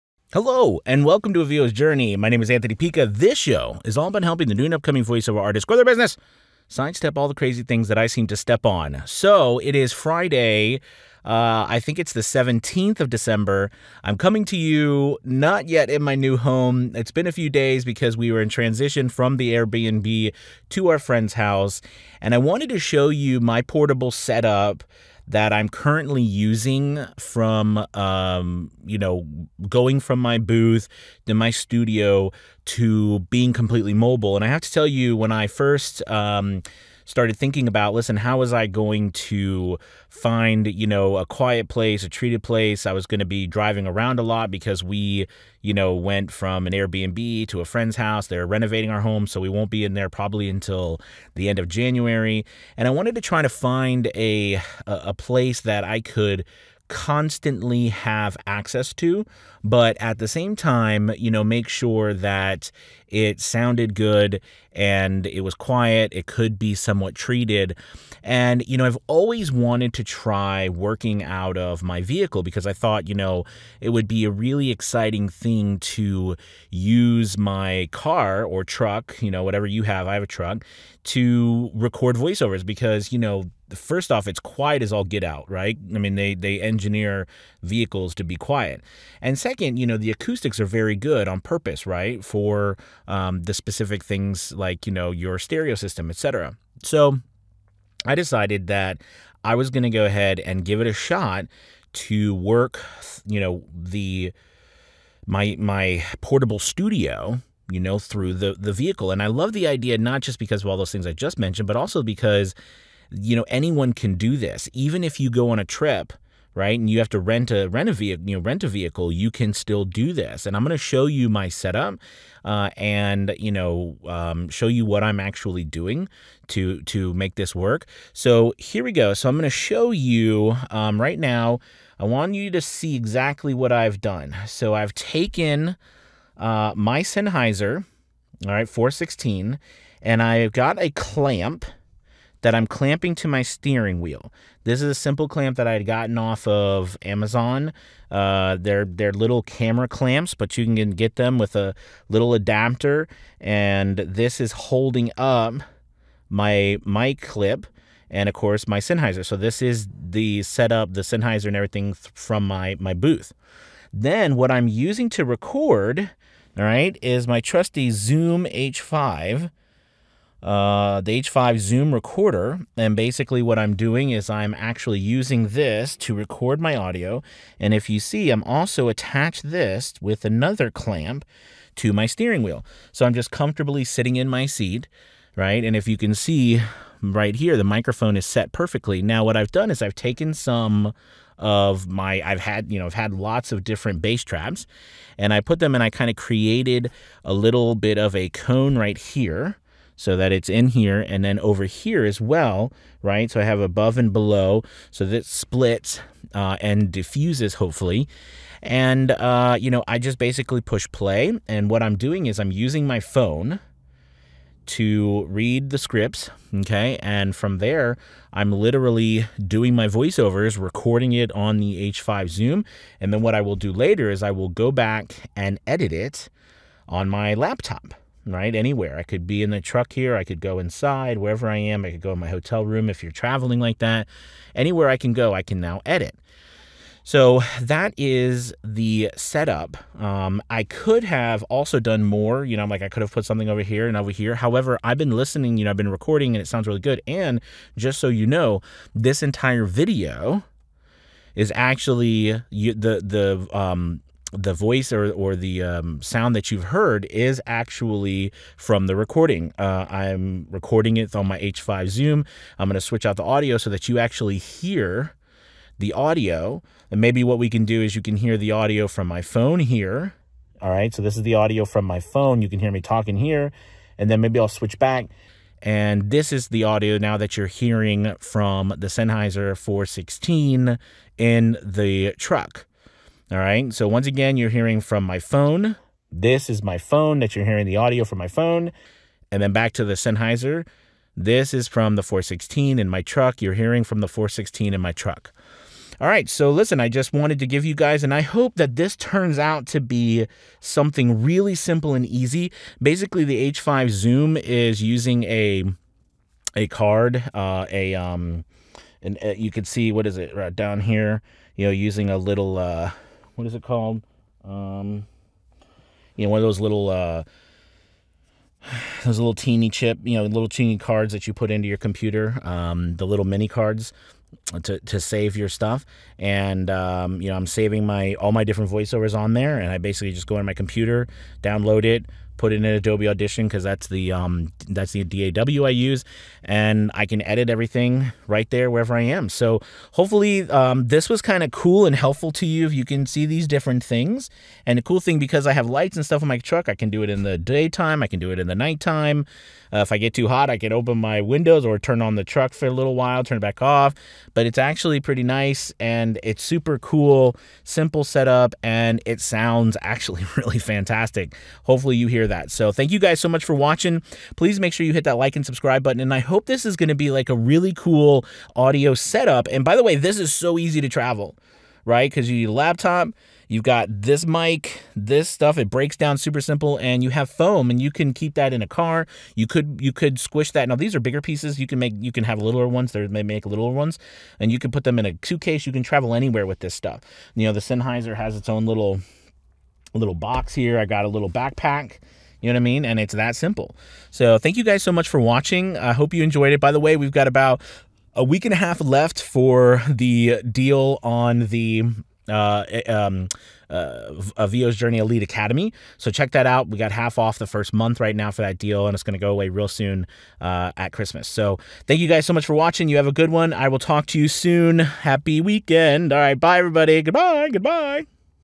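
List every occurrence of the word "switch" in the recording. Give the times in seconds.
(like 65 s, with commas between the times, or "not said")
262 s, 274 s.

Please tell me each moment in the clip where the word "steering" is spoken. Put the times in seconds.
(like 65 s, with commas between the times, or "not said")
143 s, 182 s.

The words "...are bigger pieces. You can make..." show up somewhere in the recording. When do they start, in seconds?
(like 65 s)
380 s.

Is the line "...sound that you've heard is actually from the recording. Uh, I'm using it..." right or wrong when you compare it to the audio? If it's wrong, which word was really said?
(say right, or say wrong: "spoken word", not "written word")
wrong: "recording", not "using".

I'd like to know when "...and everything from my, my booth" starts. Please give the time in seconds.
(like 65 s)
161 s.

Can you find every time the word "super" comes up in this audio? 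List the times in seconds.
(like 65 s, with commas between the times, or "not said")
356 s, 376 s.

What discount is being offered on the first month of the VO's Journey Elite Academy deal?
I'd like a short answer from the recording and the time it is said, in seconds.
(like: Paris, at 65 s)
Half off, at 406 s.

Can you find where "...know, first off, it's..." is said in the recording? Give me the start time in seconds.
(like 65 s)
83 s.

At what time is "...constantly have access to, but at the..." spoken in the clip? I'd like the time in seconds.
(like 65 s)
56 s.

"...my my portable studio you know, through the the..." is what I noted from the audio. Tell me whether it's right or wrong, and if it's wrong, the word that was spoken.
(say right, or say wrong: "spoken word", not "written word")
right.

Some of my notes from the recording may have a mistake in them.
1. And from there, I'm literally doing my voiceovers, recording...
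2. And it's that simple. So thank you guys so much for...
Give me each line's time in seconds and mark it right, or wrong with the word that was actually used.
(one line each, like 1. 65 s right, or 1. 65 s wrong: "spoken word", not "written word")
1. 217 s right
2. 392 s right.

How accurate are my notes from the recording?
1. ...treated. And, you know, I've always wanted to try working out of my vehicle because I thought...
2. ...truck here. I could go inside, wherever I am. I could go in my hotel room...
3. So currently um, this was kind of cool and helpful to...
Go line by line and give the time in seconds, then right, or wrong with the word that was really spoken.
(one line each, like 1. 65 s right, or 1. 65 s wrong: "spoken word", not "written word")
1. 67 s right
2. 229 s right
3. 339 s wrong: "hopefully", not "currently".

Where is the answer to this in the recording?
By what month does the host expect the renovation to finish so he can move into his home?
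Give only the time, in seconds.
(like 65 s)
51 s.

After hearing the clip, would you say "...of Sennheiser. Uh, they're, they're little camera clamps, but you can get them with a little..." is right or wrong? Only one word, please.
wrong.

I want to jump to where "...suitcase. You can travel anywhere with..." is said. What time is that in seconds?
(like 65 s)
385 s.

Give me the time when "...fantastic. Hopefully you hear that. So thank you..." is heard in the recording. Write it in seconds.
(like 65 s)
360 s.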